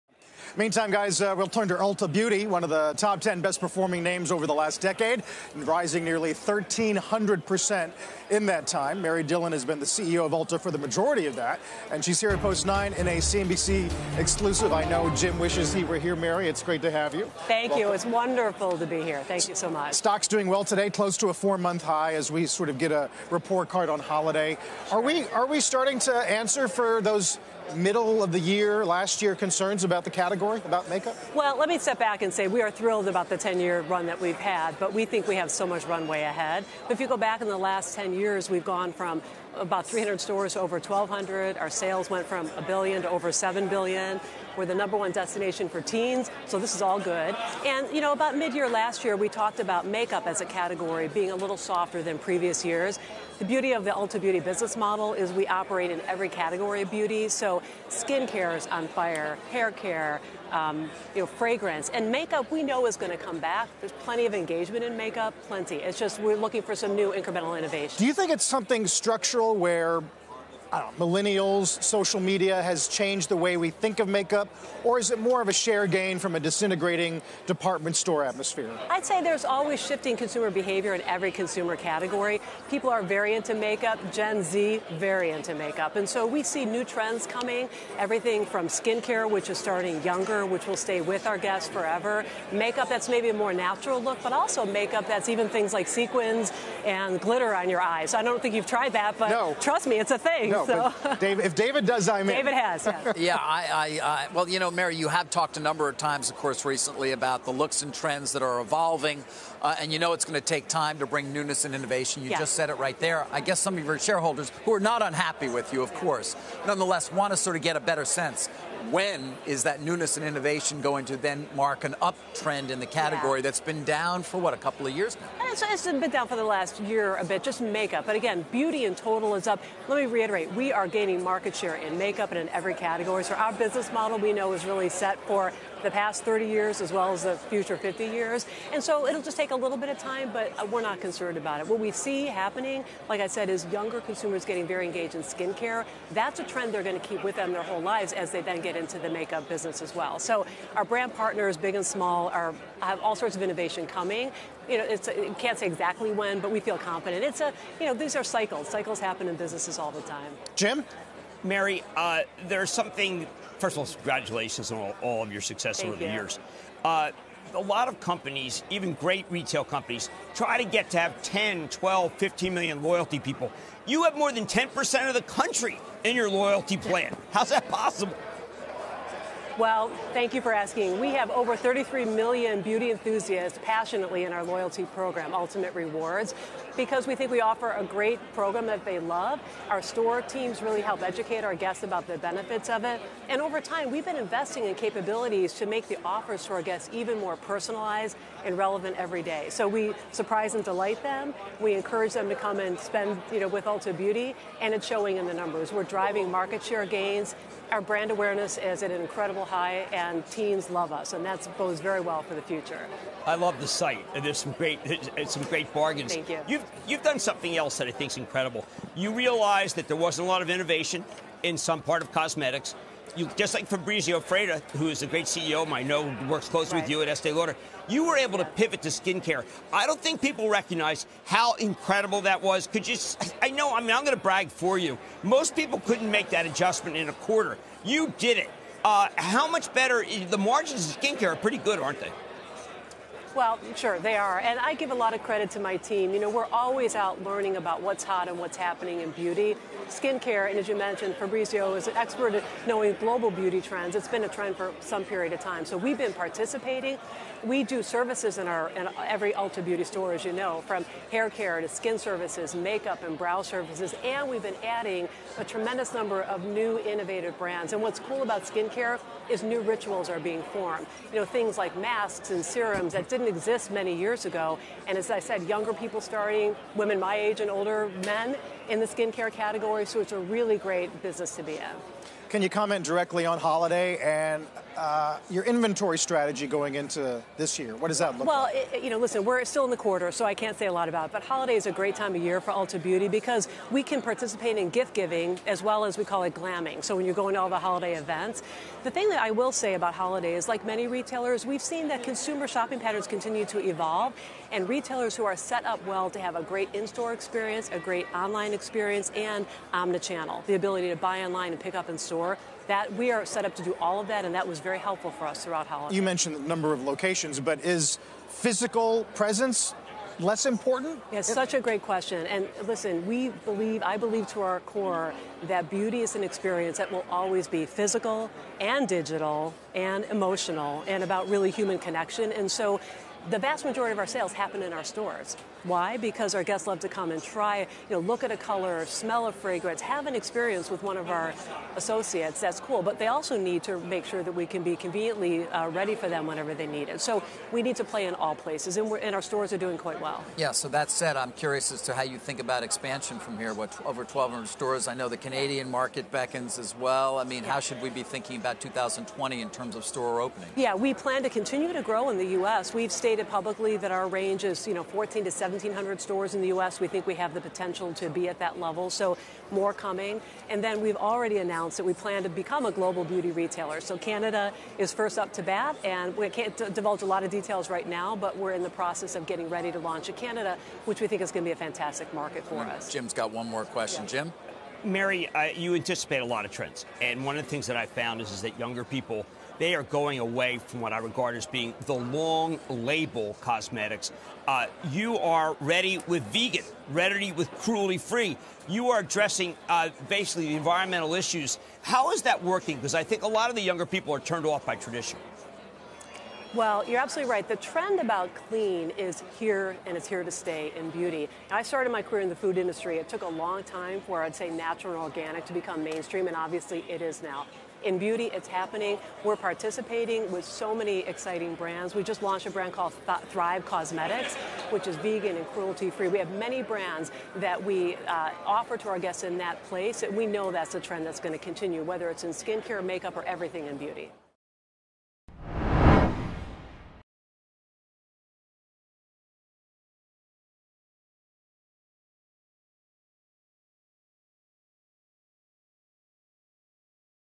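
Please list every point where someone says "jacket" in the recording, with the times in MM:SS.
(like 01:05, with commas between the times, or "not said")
not said.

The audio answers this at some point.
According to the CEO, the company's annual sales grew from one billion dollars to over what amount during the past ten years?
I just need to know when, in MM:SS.
00:43.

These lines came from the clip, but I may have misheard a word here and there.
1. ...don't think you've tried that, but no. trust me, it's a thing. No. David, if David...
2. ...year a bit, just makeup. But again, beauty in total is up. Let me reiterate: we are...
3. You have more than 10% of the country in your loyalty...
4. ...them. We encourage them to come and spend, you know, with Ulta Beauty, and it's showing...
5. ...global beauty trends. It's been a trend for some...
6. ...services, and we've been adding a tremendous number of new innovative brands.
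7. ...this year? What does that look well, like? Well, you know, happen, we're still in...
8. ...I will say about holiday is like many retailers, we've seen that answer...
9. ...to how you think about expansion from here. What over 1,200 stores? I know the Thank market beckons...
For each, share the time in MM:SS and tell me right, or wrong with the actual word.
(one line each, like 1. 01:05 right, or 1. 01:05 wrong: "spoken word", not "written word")
1. 01:38 right
2. 02:06 right
3. 02:53 right
4. 03:21 right
5. 04:12 right
6. 04:23 right
7. 04:47 wrong: "listen", not "happen"
8. 04:59 wrong: "consumer", not "answer"
9. 05:51 wrong: "Canadian", not "Thank".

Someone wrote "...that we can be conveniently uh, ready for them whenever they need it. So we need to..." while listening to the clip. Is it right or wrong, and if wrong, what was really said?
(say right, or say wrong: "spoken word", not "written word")
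right.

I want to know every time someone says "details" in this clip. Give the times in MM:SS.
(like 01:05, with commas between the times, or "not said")
06:17.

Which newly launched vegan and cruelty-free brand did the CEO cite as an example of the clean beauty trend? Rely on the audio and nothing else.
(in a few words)
Thrive Causemetics.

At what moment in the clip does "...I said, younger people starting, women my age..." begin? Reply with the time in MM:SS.
04:35.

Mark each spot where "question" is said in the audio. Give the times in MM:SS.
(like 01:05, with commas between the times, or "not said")
05:21, 06:23.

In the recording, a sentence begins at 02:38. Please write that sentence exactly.
Cycles happen in businesses all the time.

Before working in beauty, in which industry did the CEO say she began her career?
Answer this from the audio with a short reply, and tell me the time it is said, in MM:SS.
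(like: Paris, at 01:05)
Food industry, at 06:52.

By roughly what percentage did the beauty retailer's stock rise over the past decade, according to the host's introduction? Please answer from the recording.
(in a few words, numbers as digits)
1,300%.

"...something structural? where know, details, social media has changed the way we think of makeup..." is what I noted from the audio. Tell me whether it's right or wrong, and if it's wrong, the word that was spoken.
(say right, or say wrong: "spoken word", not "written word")
wrong: "millennials", not "details".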